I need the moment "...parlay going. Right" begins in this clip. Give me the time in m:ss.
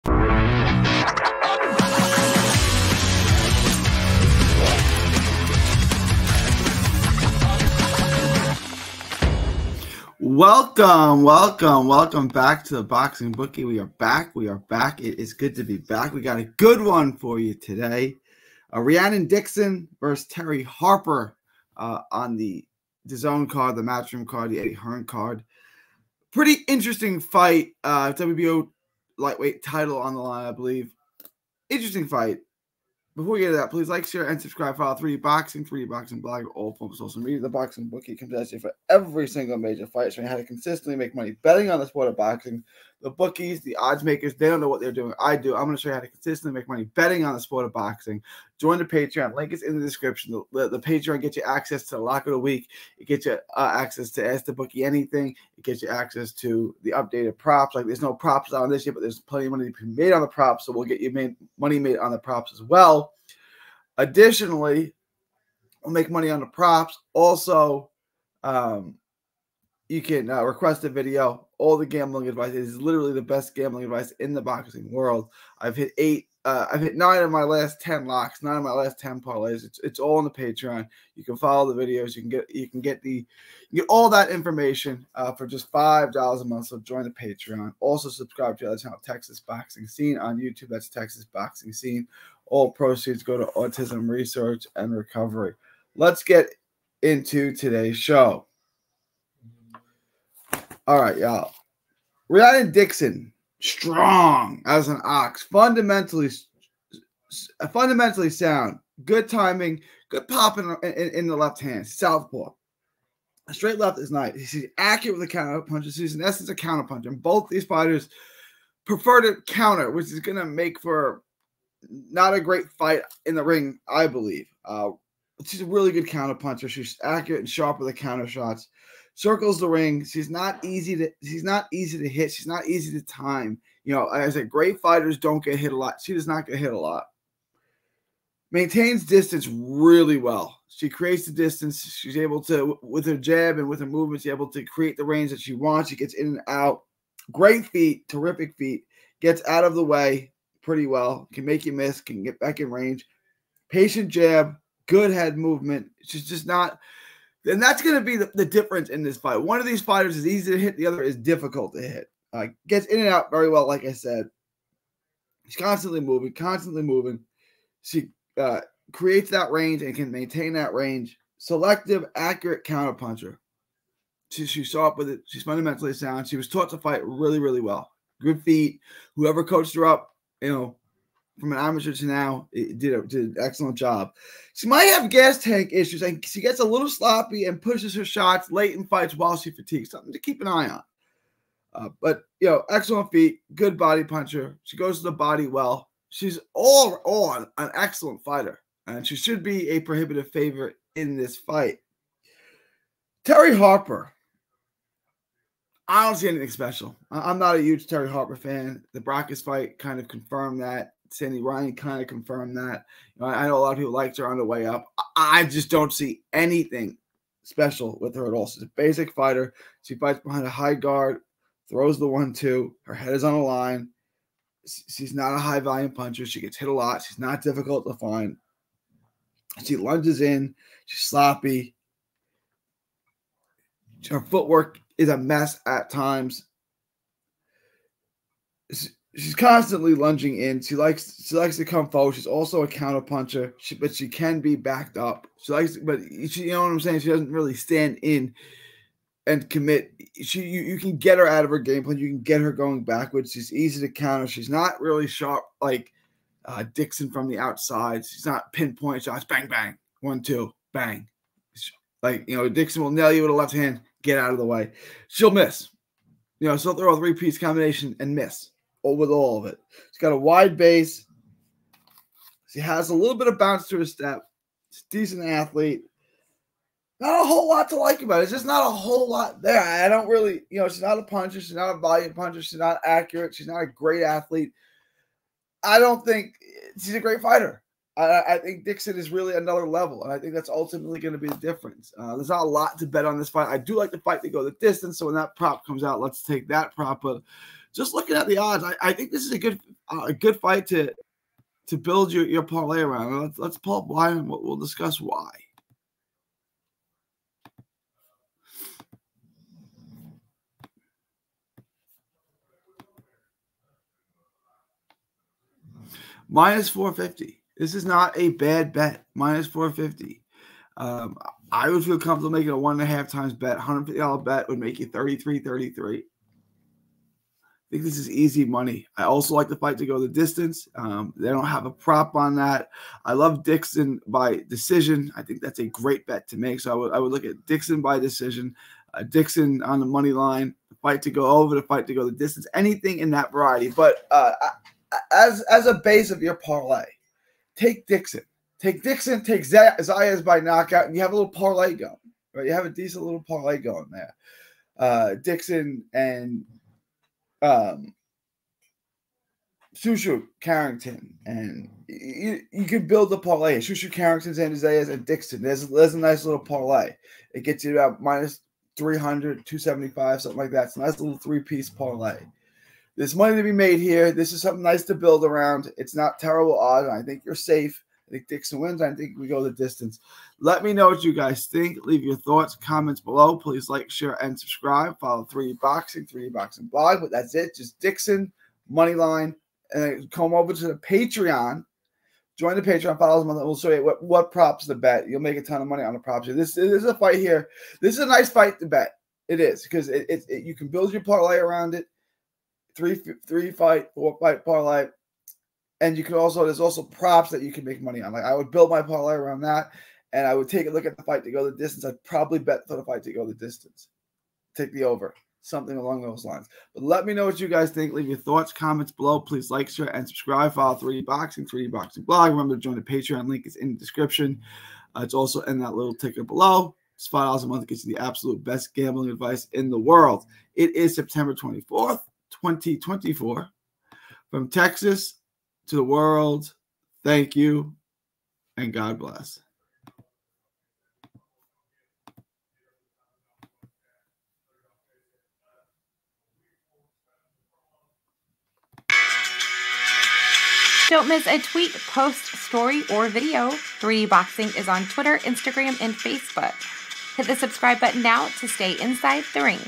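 5:51.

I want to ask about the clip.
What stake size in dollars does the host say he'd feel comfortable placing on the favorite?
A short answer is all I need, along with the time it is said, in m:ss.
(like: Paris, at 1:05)
$150, at 5:23.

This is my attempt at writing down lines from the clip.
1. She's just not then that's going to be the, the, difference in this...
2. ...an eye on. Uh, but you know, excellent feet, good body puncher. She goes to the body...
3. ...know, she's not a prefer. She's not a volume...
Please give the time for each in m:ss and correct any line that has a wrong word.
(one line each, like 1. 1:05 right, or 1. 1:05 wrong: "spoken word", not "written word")
1. 2:36 right
2. 3:10 right
3. 4:40 wrong: "puncher", not "prefer".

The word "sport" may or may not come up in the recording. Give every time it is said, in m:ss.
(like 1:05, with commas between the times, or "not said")
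0:41, 0:47.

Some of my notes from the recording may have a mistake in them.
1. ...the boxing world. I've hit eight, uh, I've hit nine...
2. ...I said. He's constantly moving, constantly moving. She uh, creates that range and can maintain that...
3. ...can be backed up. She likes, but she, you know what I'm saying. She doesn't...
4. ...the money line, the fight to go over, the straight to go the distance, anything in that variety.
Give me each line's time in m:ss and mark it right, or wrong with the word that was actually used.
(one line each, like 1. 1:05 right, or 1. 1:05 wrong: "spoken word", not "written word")
1. 1:14 right
2. 2:43 right
3. 4:04 right
4. 5:39 wrong: "fight", not "straight".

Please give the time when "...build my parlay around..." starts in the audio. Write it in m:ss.
6:48.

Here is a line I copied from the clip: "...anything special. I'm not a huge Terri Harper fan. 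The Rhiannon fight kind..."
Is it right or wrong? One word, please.
wrong.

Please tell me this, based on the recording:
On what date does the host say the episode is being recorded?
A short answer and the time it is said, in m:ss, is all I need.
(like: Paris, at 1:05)
September 24th, 2024, at 7:10.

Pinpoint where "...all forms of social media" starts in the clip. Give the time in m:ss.
0:36.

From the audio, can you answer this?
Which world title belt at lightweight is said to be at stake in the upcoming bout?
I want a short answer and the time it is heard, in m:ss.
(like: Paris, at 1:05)
WBO, at 0:28.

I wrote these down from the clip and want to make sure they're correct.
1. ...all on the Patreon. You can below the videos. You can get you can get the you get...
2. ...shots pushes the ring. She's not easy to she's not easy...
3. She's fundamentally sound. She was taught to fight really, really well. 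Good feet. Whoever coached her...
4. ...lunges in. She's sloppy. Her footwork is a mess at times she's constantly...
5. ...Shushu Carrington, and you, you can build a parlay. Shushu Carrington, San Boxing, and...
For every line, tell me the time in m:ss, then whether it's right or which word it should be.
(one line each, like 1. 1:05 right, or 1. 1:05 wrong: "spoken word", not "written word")
1. 1:19 wrong: "follow", not "below"
2. 2:08 wrong: "circles", not "pushes"
3. 2:55 right
4. 3:49 right
5. 5:59 wrong: "Isaias", not "Boxing".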